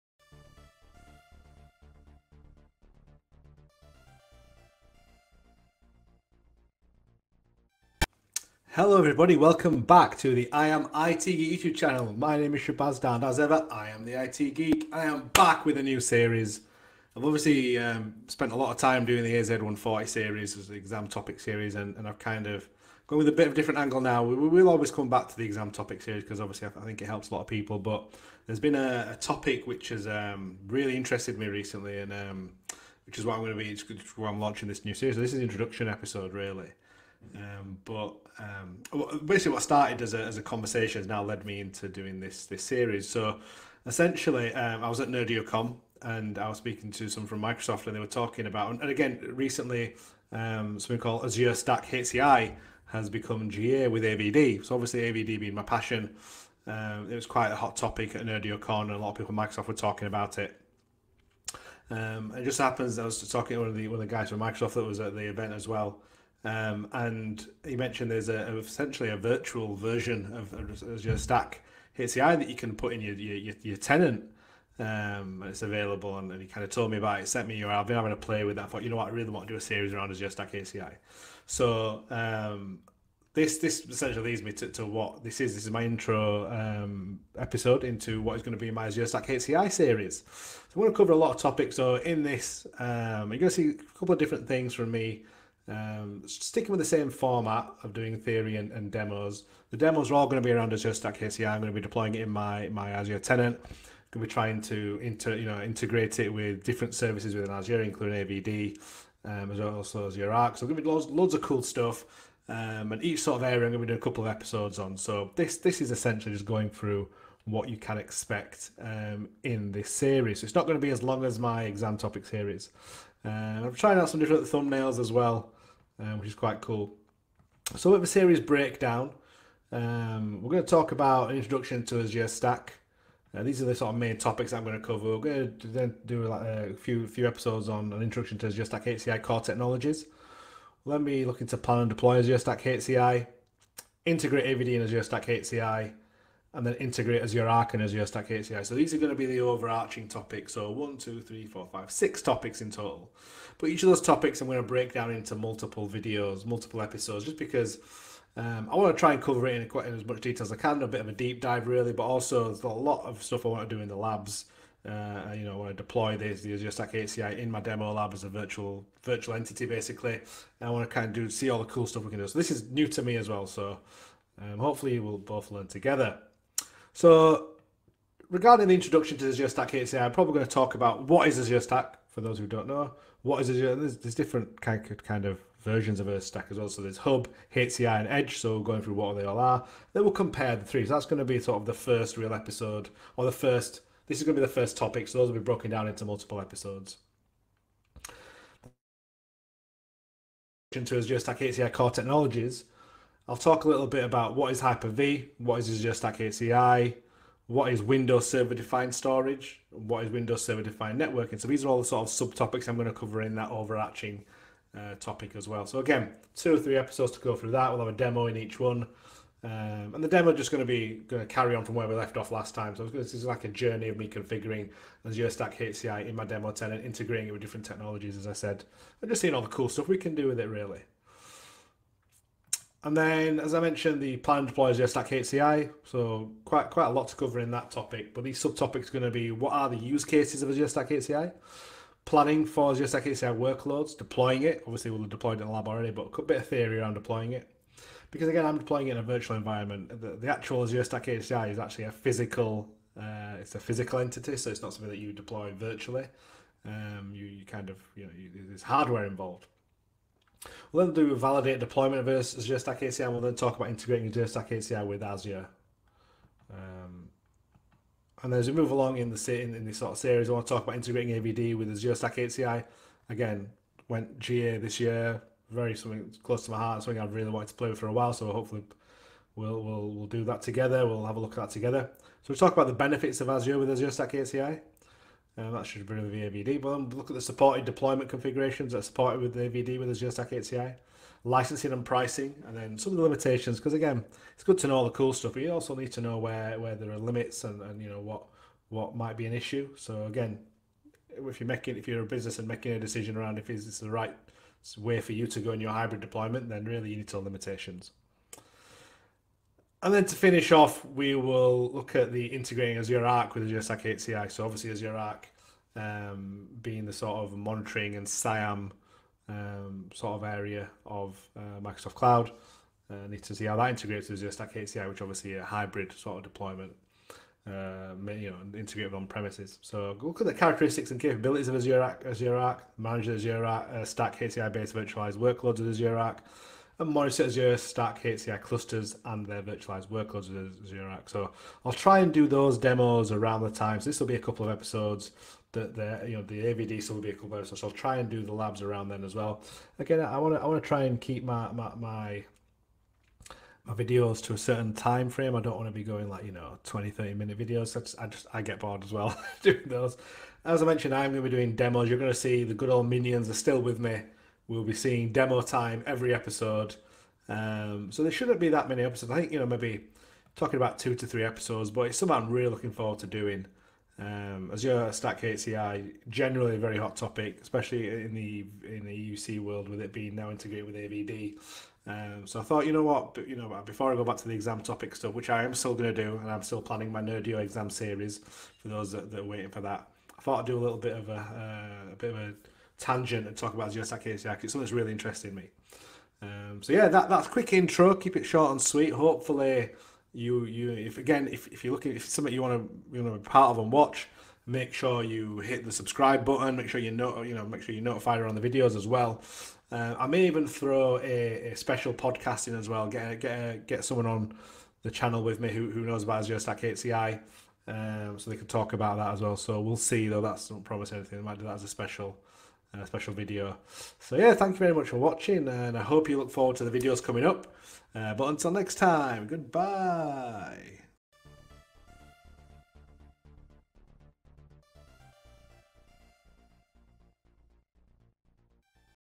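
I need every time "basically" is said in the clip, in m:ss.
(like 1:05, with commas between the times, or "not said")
0:39, 2:49.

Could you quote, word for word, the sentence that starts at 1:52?
Um, and each sort of area I'm going to be doing a couple of episodes on.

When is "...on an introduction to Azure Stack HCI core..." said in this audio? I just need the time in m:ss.
2:17.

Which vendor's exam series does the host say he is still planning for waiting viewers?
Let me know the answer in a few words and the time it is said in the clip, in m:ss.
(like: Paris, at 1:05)
Nerdio, at 6:27.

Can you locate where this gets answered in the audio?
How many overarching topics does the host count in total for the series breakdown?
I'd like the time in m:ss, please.
2:31.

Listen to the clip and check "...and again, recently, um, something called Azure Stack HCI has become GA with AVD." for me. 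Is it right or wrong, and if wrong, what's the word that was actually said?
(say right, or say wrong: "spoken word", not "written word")
right.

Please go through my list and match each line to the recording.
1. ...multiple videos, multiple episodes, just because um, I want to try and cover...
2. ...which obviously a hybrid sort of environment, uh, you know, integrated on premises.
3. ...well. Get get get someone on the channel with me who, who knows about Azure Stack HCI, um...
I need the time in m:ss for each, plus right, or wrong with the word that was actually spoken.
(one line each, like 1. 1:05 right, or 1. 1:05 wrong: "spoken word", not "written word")
1. 2:35 right
2. 5:24 wrong: "deployment", not "environment"
3. 6:52 right.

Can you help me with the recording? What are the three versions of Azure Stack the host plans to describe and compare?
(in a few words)
Hub, HCI, and Edge.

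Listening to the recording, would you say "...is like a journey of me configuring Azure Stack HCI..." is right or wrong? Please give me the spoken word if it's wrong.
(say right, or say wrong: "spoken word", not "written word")
right.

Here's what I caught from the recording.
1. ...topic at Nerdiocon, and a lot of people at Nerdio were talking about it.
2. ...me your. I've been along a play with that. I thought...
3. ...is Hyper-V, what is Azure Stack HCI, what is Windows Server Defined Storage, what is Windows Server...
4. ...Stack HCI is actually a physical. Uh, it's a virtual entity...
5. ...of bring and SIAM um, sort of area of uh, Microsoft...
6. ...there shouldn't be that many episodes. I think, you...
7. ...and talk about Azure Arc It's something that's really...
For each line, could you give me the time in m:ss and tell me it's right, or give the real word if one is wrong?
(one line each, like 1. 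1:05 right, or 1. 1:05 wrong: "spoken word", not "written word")
1. 0:57 wrong: "Microsoft", not "Nerdio"
2. 1:17 wrong: "having", not "along"
3. 3:24 right
4. 4:10 wrong: "physical", not "virtual"
5. 5:17 wrong: "monitoring", not "bring"
6. 6:08 right
7. 6:33 wrong: "Stack", not "Arc".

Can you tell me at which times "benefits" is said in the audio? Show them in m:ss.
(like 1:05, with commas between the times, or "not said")
4:42.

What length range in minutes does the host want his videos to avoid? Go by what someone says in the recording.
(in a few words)
20, 30 minutes.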